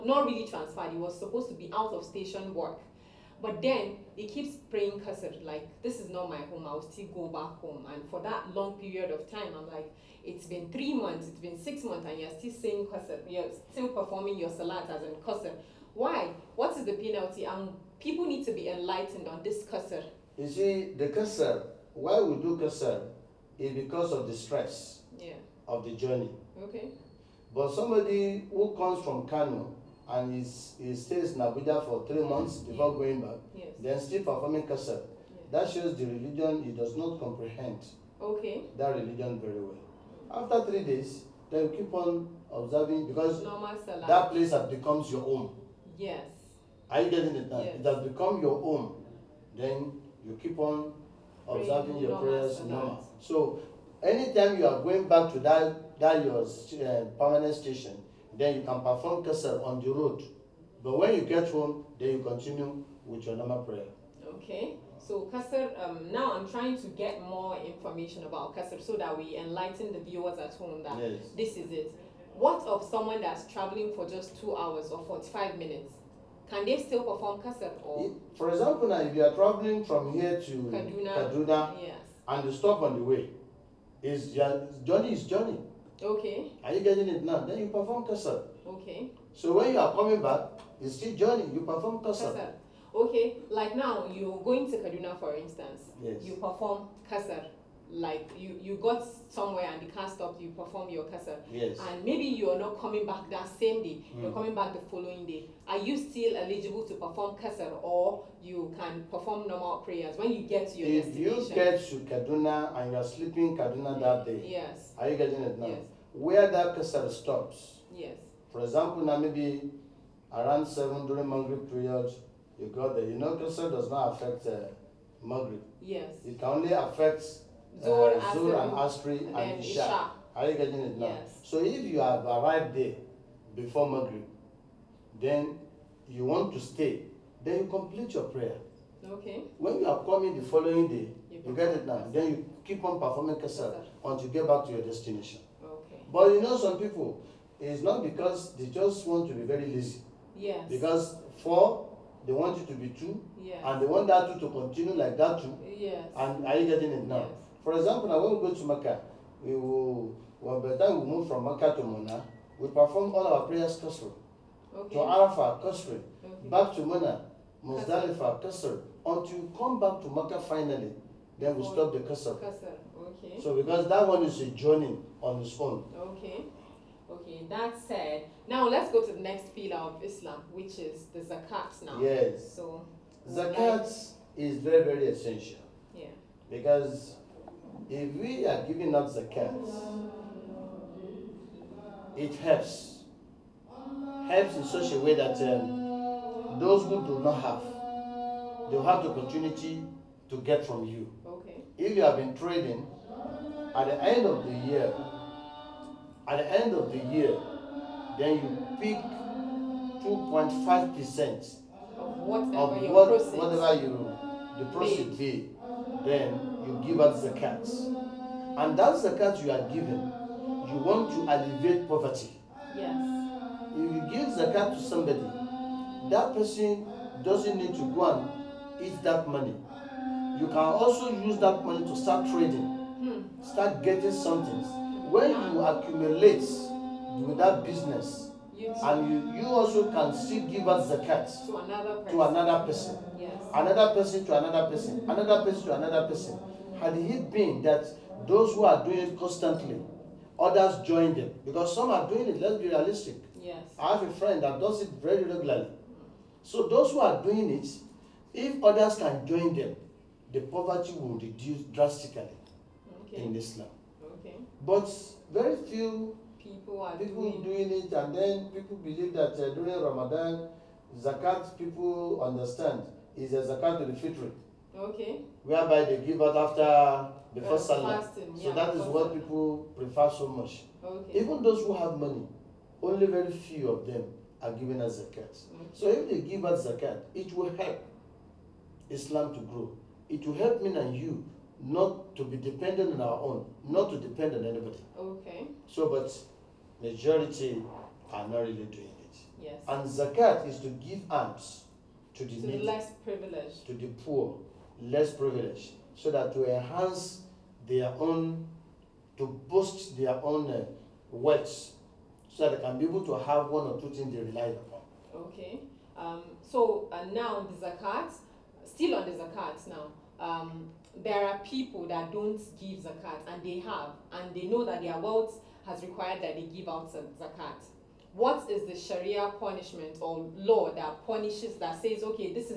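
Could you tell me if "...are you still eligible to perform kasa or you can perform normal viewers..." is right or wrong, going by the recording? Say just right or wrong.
wrong.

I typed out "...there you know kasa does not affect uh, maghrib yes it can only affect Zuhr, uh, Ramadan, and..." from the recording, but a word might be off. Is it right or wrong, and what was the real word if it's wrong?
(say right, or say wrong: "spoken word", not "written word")
wrong: "Asr", not "Ramadan".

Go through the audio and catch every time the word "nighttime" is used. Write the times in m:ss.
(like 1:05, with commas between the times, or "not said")
not said.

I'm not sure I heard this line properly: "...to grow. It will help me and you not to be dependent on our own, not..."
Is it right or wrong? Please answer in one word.
right.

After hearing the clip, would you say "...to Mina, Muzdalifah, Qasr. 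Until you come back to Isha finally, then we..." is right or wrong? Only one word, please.
wrong.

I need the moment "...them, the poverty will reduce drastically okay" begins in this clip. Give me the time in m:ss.
4:19.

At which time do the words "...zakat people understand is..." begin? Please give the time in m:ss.
4:30.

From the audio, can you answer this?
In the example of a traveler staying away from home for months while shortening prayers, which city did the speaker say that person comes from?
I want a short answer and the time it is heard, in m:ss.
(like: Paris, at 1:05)
Kano, at 0:29.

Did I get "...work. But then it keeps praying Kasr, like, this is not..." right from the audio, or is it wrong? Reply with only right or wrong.
right.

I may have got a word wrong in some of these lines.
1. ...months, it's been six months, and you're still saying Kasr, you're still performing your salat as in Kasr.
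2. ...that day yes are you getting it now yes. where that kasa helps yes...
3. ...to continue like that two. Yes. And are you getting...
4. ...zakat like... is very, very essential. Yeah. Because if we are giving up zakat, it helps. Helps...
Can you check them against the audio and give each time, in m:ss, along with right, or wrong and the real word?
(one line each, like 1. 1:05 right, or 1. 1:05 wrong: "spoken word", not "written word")
1. 0:10 right
2. 1:53 wrong: "stops", not "helps"
3. 2:34 right
4. 3:03 right.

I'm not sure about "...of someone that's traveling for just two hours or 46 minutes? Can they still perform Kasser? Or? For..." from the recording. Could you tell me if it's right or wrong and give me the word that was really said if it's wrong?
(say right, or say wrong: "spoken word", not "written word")
wrong: "45", not "46".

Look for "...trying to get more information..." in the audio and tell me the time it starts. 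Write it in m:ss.
1:06.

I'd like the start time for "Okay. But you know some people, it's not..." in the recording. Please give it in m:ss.
2:25.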